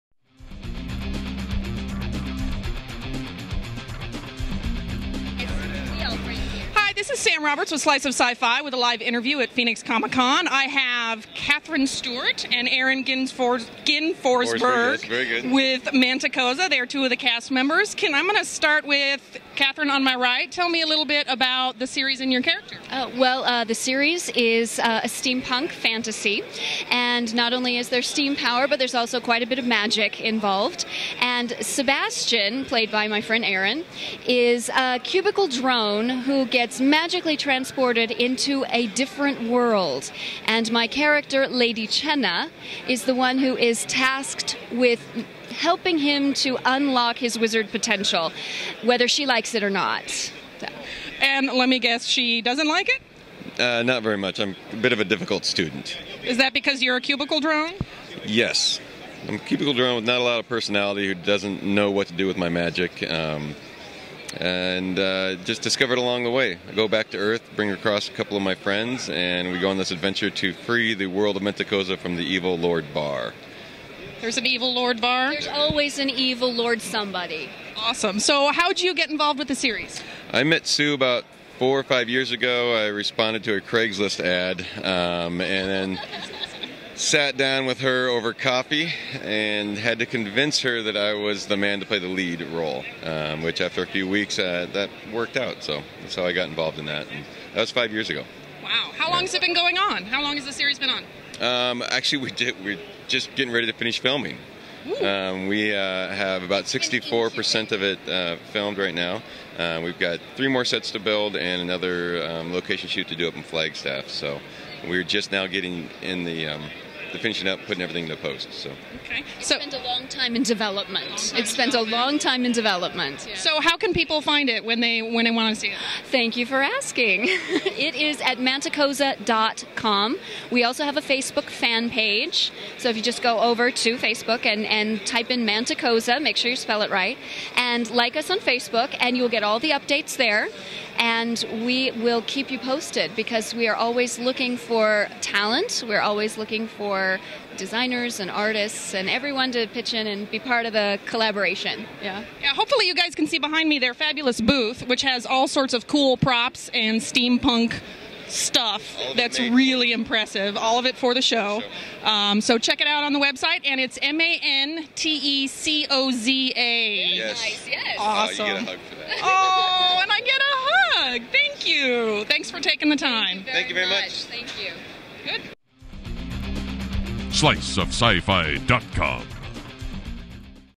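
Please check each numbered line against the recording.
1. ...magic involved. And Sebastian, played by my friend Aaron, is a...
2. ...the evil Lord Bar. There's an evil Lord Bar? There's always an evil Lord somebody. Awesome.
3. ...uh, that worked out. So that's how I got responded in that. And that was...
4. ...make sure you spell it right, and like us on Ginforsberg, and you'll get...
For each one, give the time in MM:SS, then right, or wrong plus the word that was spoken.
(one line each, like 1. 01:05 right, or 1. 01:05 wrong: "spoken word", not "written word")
1. 00:29 right
2. 01:12 right
3. 01:34 wrong: "involved", not "responded"
4. 02:16 wrong: "Facebook", not "Ginforsberg".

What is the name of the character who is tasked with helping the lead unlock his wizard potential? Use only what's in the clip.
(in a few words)
Lady Chenna.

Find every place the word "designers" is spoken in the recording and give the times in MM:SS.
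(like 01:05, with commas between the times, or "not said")
02:27.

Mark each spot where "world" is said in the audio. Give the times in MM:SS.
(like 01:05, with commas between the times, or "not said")
00:39, 01:11.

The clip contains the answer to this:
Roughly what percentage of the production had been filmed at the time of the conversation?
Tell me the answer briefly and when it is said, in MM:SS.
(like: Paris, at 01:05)
64%, at 01:46.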